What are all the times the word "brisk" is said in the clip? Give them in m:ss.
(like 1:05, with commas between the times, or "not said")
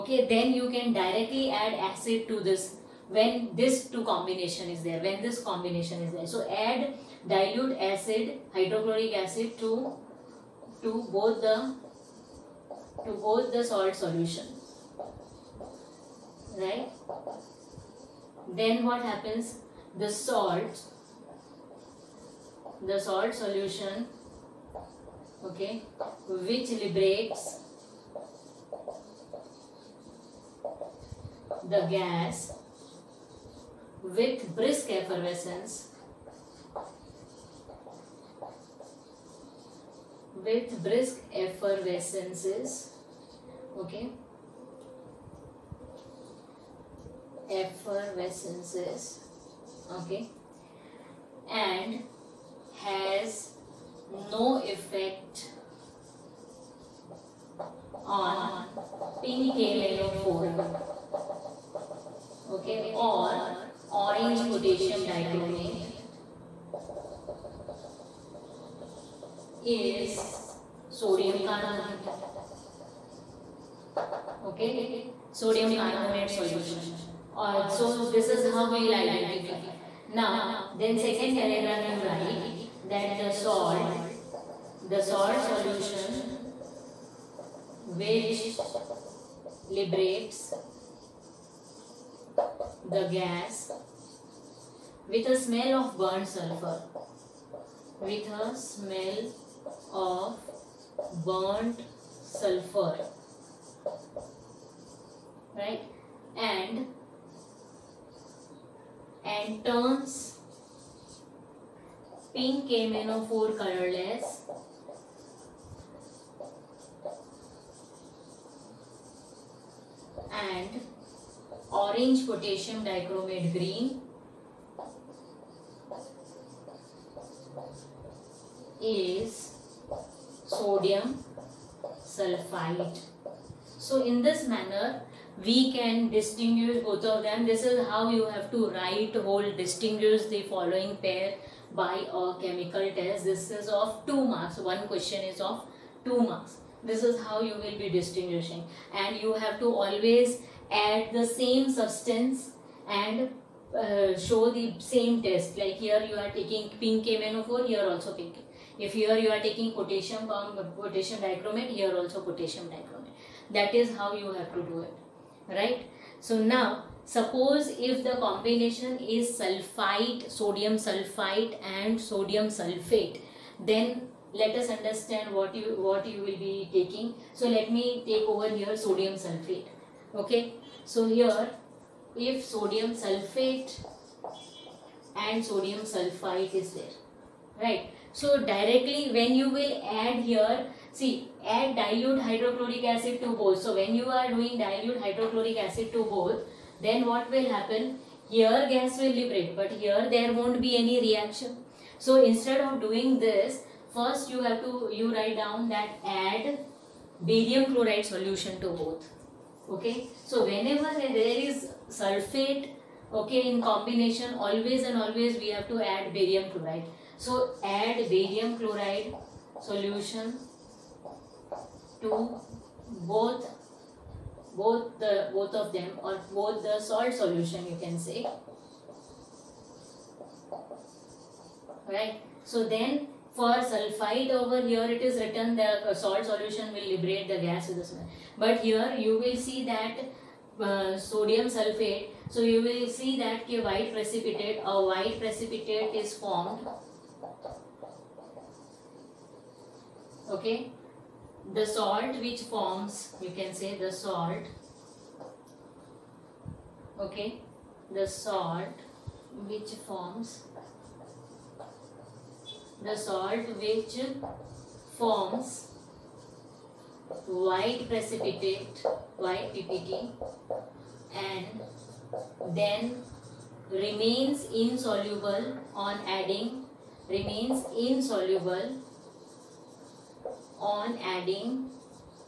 0:34, 0:40.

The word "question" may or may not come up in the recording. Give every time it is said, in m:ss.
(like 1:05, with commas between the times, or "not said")
2:24.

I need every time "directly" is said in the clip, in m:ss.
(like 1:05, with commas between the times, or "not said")
0:00, 3:08.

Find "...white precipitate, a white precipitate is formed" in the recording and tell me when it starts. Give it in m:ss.
4:03.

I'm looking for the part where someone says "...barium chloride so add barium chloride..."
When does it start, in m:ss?
3:36.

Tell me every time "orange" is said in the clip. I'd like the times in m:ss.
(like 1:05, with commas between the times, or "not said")
1:03, 2:01.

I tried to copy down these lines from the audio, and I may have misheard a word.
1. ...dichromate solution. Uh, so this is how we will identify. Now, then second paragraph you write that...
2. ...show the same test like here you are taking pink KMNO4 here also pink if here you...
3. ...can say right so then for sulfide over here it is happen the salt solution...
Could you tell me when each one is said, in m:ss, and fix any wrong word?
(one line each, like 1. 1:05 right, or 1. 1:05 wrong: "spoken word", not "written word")
1. 1:15 wrong: "carbonate", not "dichromate"
2. 2:34 right
3. 3:47 wrong: "written", not "happen".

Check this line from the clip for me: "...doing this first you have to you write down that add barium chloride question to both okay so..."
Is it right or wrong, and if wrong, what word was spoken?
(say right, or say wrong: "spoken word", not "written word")
wrong: "solution", not "question".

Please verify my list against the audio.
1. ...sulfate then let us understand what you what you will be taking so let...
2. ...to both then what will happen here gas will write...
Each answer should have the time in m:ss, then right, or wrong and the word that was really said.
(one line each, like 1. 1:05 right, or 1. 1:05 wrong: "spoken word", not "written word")
1. 2:52 right
2. 3:15 wrong: "liberate", not "write".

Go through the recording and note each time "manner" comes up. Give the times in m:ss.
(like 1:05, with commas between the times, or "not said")
2:14.